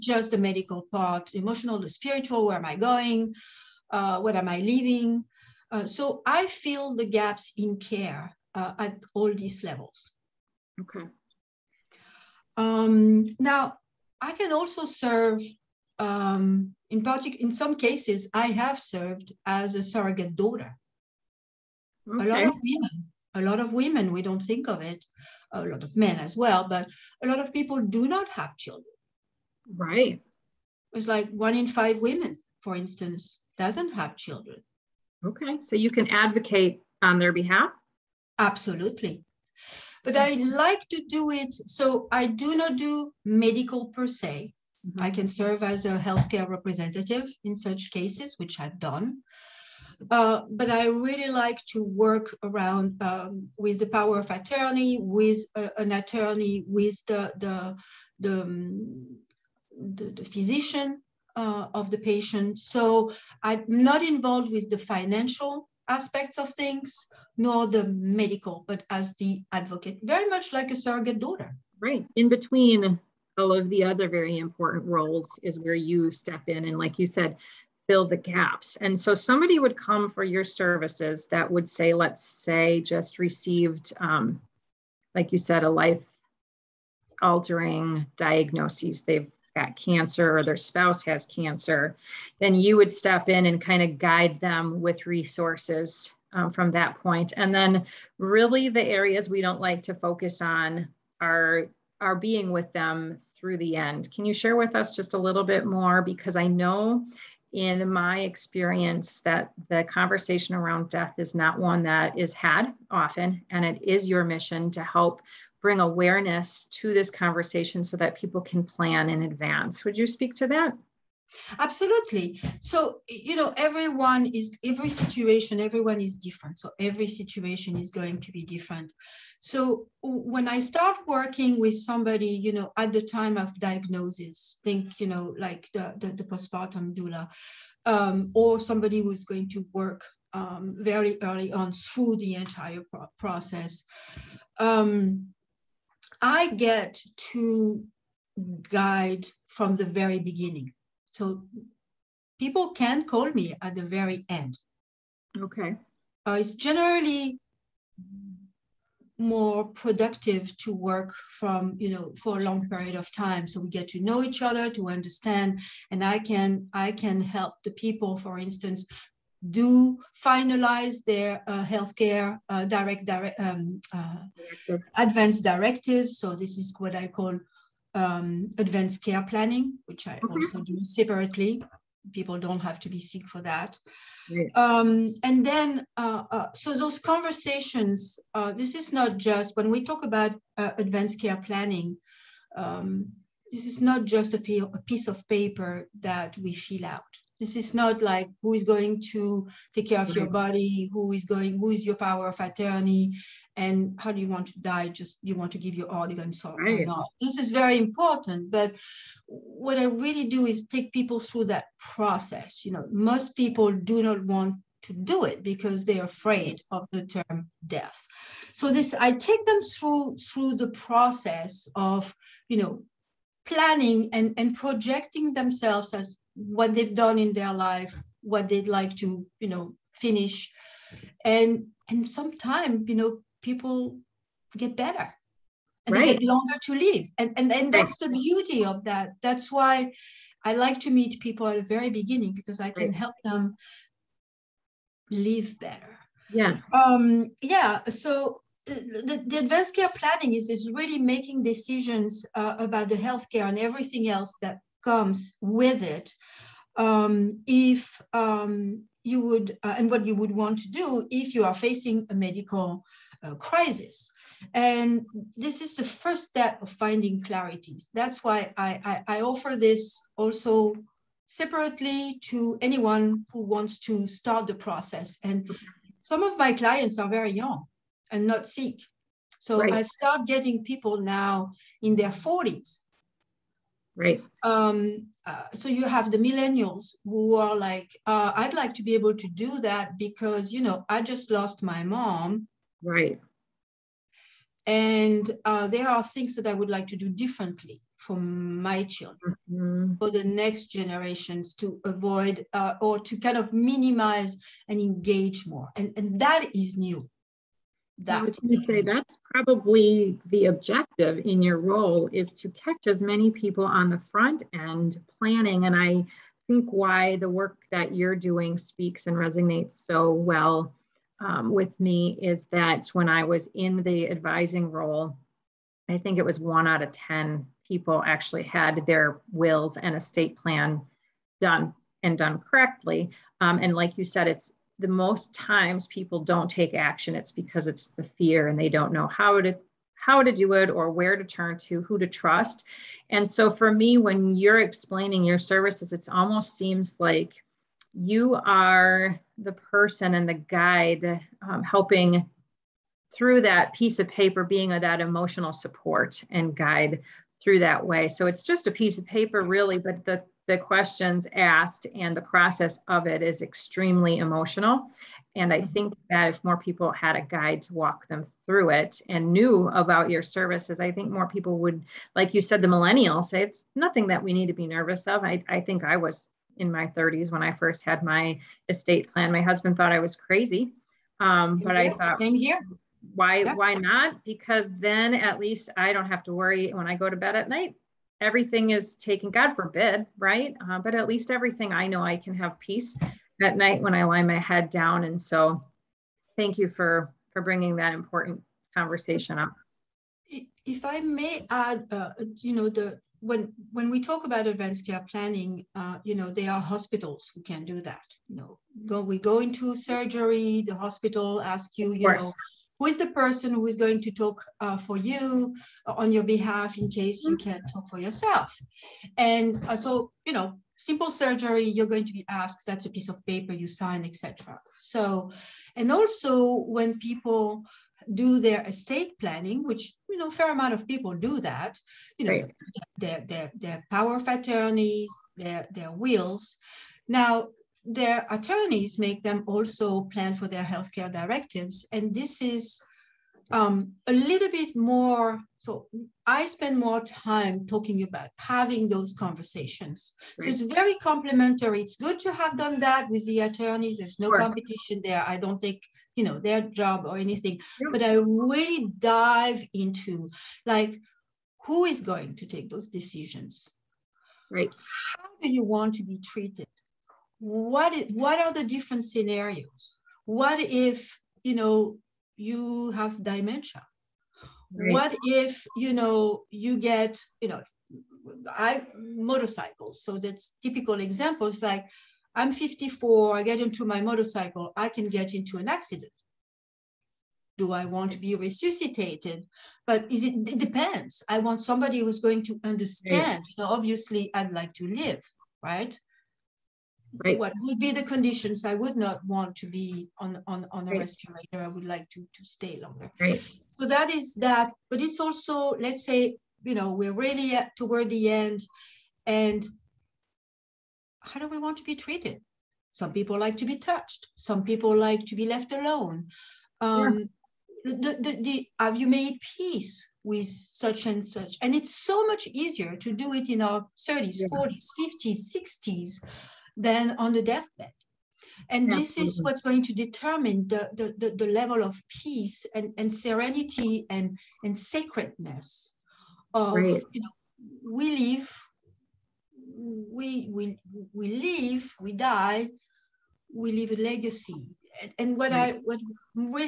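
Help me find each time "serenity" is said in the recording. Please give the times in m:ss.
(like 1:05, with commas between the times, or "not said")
8:53.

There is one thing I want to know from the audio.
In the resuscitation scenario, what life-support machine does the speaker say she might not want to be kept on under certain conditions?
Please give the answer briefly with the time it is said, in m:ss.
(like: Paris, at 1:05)
respirator, at 8:21.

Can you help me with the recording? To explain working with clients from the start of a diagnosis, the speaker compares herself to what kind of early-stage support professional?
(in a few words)
postpartum doula.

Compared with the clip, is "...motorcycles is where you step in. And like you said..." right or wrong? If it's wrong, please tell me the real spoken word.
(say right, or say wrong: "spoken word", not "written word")
wrong: "roles", not "motorcycles".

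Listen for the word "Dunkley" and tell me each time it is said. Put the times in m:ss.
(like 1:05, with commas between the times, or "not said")
not said.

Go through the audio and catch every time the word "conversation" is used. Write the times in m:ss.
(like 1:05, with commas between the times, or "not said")
1:49, 1:57, 3:07, 6:38, 7:29.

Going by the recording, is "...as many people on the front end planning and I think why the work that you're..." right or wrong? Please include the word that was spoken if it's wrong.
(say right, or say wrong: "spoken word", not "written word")
right.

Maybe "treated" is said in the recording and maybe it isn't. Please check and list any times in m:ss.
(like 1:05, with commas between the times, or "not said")
7:46, 8:31.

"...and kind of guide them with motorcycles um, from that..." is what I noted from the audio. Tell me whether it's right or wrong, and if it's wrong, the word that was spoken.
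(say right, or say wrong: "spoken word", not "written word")
wrong: "resources", not "motorcycles".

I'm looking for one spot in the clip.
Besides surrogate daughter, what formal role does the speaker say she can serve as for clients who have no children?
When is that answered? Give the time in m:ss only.
0:45.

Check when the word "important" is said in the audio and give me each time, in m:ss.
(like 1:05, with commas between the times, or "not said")
1:14, 3:27, 6:37.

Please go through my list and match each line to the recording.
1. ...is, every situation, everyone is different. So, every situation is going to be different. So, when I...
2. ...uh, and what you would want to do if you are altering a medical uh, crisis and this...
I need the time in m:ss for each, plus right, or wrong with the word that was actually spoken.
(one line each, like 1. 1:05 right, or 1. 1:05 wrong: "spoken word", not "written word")
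1. 2:04 right
2. 4:19 wrong: "facing", not "altering".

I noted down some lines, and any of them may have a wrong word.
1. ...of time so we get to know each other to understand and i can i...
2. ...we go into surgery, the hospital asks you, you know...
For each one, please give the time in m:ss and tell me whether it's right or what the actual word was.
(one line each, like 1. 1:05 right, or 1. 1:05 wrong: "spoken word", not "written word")
1. 2:42 right
2. 6:49 right.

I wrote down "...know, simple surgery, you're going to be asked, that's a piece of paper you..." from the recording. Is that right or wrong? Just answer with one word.
right.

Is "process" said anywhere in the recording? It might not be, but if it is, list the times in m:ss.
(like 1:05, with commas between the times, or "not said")
2:23, 3:31, 3:40, 4:34, 6:02.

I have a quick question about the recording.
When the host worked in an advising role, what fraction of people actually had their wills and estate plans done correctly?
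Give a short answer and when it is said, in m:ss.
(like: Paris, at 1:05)
1 out of 10, at 5:26.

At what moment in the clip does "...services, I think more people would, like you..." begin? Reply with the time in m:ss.
6:10.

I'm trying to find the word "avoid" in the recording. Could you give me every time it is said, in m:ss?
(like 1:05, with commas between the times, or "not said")
5:01.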